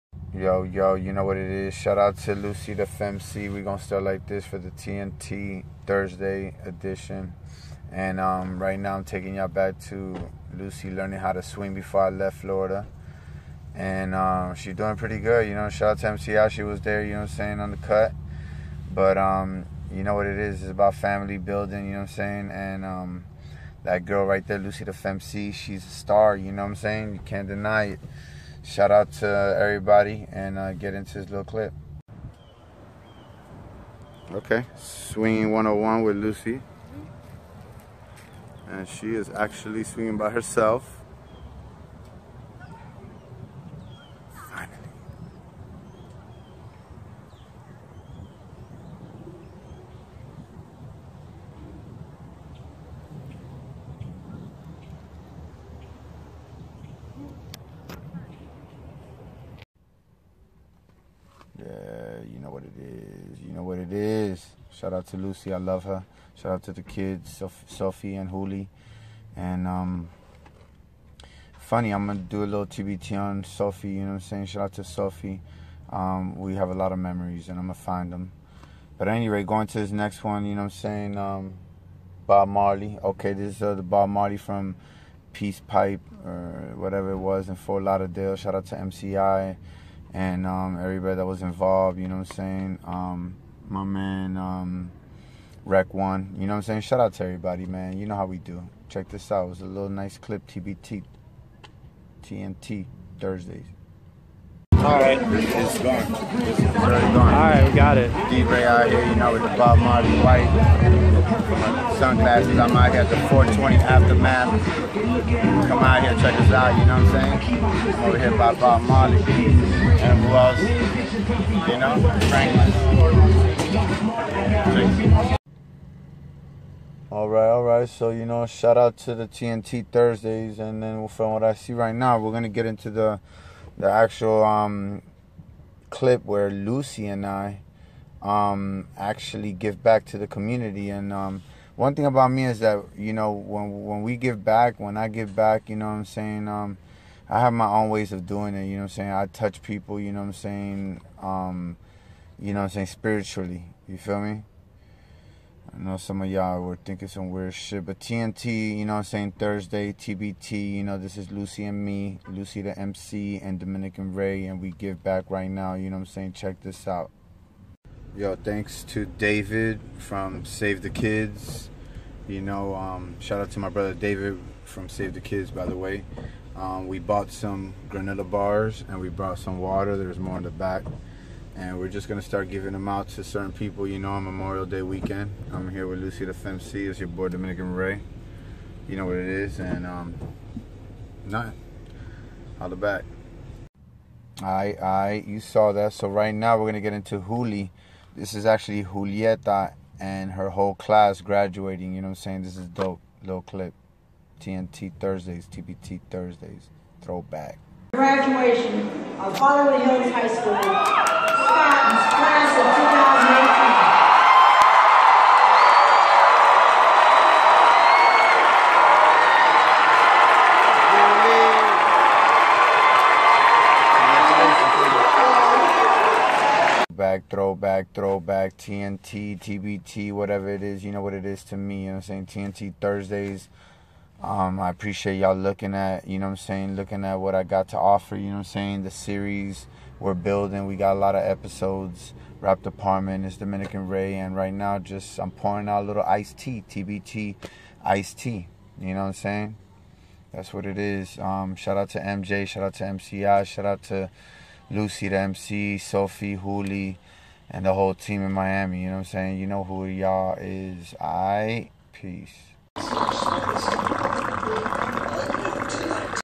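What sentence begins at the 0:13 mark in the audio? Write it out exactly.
And um, she's doing pretty good.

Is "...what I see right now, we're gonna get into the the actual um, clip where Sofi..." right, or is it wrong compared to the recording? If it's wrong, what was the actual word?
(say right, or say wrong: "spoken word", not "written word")
wrong: "Luci", not "Sofi".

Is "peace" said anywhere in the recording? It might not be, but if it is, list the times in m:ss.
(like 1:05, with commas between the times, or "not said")
1:25, 4:21.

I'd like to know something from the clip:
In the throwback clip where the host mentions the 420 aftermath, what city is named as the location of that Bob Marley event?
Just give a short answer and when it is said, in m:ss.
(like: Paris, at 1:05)
Fort Lauderdale, at 1:27.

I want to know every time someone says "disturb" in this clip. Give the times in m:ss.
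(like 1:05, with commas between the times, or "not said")
not said.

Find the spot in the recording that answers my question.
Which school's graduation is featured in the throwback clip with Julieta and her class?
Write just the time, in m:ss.
3:29.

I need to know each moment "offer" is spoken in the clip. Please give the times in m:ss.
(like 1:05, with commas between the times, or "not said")
3:57.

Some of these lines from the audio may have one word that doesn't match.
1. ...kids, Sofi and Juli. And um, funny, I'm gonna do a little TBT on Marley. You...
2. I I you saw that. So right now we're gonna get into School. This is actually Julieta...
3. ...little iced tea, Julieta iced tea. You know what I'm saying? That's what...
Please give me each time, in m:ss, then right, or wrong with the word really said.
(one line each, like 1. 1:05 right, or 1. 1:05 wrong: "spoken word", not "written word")
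1. 1:06 wrong: "Sofi", not "Marley"
2. 3:14 wrong: "Juli", not "School"
3. 4:05 wrong: "TBT", not "Julieta".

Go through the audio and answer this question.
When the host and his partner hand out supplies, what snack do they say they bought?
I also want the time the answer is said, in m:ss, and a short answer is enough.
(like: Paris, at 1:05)
Granola bars, at 2:57.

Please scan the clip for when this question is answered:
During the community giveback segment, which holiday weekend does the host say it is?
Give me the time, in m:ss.
3:04.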